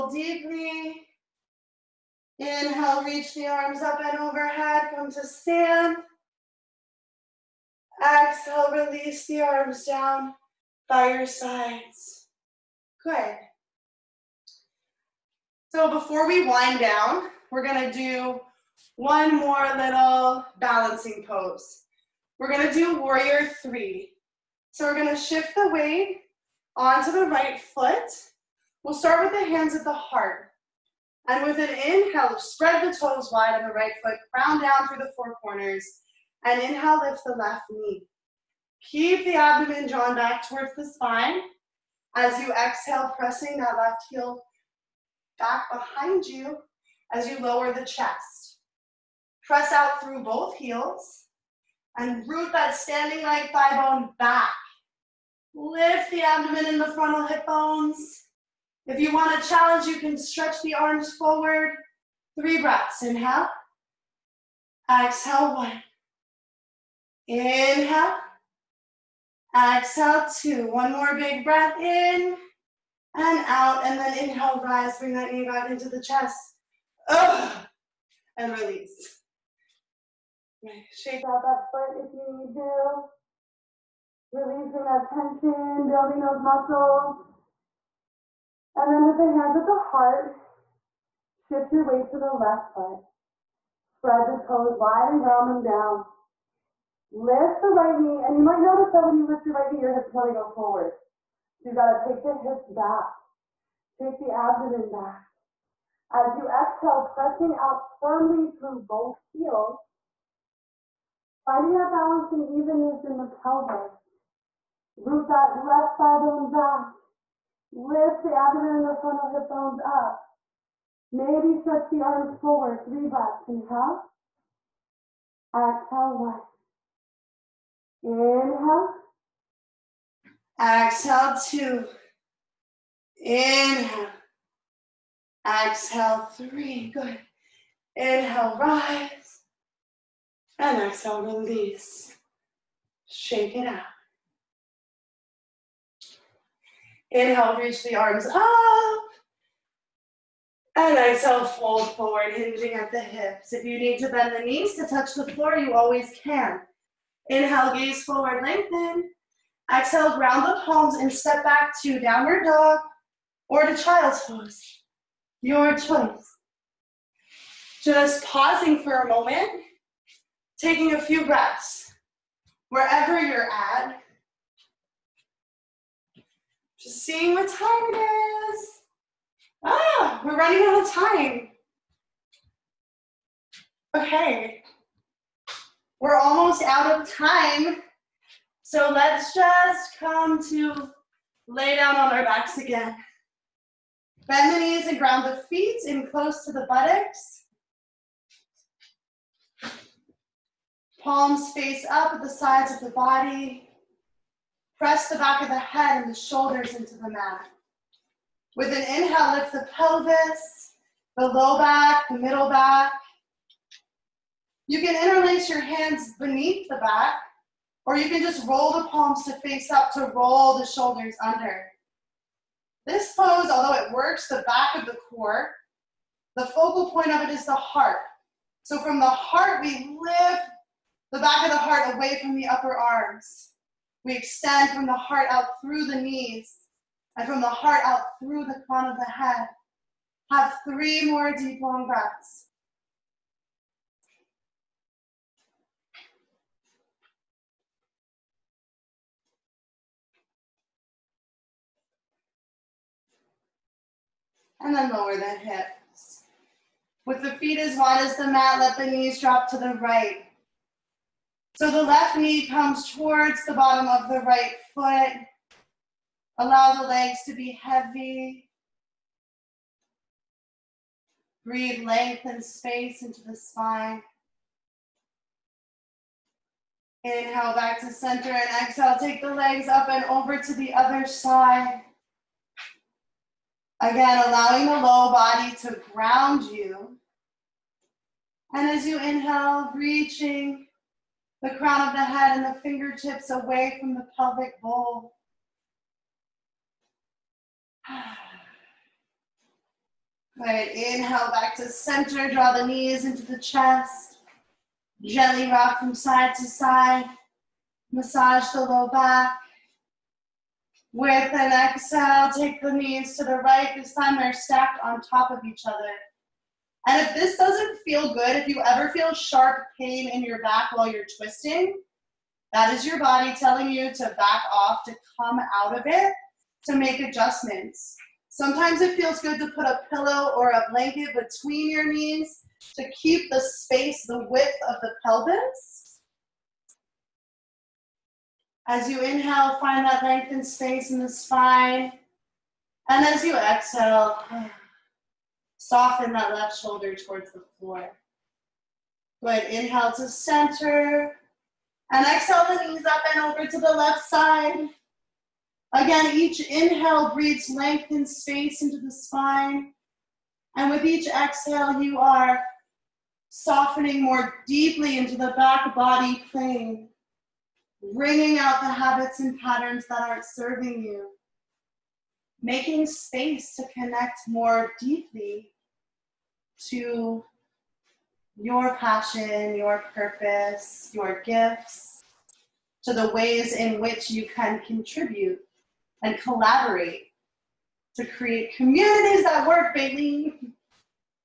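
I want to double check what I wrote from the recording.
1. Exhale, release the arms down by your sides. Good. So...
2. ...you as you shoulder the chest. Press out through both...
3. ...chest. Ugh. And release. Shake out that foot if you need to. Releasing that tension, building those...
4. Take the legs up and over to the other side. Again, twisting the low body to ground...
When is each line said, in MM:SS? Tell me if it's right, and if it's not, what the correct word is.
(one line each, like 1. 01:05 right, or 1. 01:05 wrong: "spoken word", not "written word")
1. 00:08 right
2. 00:46 wrong: "lower", not "shoulder"
3. 01:16 right
4. 04:38 wrong: "allowing", not "twisting".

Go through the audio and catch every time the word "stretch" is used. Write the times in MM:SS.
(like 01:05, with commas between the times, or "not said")
01:00, 02:01.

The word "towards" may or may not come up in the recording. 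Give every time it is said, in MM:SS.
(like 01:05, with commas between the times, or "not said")
00:40, 04:22, 05:46.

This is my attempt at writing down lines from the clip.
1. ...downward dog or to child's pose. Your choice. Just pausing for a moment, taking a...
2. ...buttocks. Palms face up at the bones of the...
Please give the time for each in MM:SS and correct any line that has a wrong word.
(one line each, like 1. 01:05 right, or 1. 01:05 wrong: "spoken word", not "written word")
1. 02:41 right
2. 03:16 wrong: "sides", not "bones".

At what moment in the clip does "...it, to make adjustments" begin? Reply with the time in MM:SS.
05:25.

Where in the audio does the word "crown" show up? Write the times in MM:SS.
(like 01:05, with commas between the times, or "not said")
00:34, 03:58, 04:51.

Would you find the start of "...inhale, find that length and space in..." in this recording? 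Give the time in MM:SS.
05:39.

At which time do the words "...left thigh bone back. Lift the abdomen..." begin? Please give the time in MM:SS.
01:55.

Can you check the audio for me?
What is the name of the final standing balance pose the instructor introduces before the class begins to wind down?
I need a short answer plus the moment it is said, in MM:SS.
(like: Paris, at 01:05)
Warrior three, at 00:23.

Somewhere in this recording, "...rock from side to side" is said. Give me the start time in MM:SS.
05:05.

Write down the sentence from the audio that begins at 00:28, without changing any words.
We'll start with the hands at the heart.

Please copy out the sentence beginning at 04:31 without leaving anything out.
Breathe length and space into the spine.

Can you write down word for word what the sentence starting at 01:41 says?
So you gotta take the hips back.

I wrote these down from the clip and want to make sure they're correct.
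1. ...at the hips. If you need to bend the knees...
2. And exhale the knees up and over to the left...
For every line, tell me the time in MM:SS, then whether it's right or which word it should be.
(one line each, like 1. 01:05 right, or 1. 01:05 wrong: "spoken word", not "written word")
1. 02:32 right
2. 05:51 right.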